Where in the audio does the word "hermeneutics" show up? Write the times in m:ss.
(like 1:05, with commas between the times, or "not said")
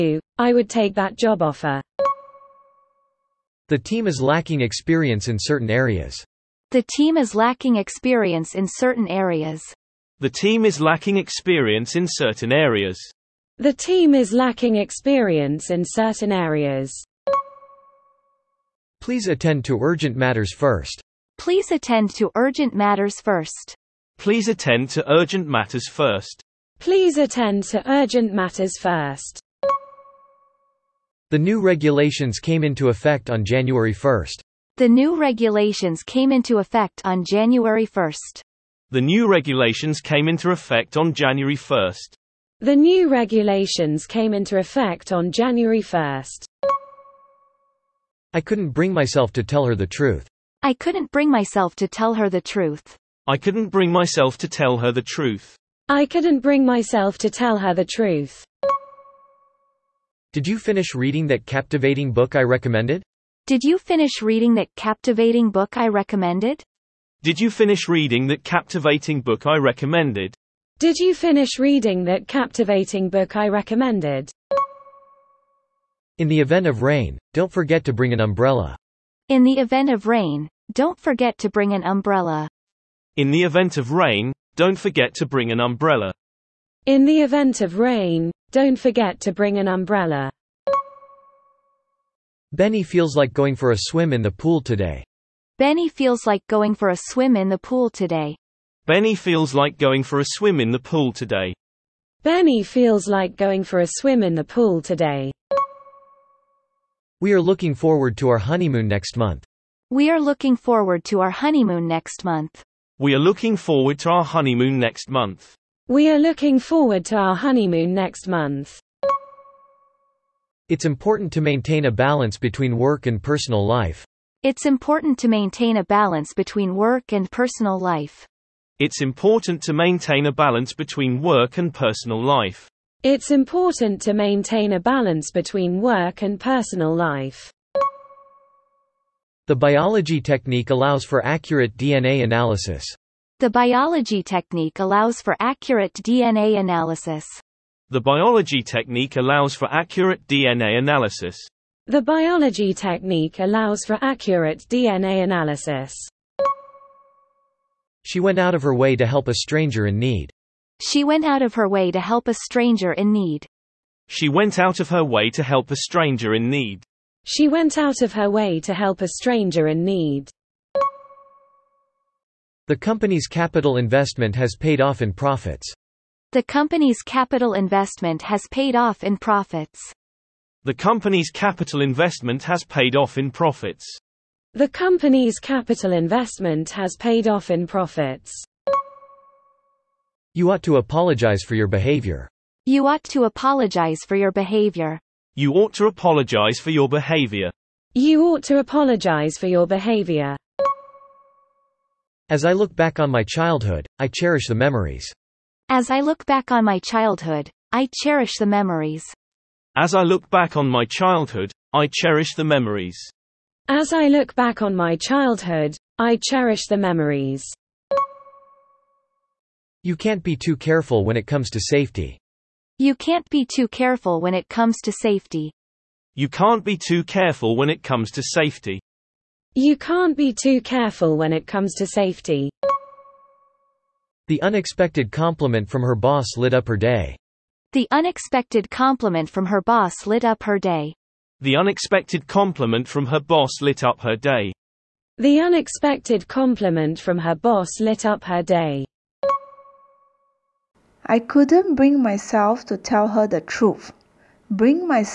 not said.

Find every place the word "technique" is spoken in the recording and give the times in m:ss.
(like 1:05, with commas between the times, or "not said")
2:20, 2:24, 2:28, 2:32.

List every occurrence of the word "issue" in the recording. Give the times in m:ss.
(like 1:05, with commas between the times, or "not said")
not said.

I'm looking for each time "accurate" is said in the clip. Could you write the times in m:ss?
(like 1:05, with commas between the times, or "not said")
2:21, 2:25, 2:29, 2:34.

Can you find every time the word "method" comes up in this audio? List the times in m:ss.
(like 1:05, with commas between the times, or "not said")
not said.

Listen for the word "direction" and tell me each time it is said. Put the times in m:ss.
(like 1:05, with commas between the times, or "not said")
not said.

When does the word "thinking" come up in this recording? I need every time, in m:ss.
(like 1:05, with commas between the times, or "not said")
not said.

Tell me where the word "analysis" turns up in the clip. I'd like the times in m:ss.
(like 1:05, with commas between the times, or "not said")
2:22, 2:26, 2:30, 2:35.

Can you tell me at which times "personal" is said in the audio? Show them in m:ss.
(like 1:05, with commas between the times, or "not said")
2:03, 2:07, 2:11, 2:16.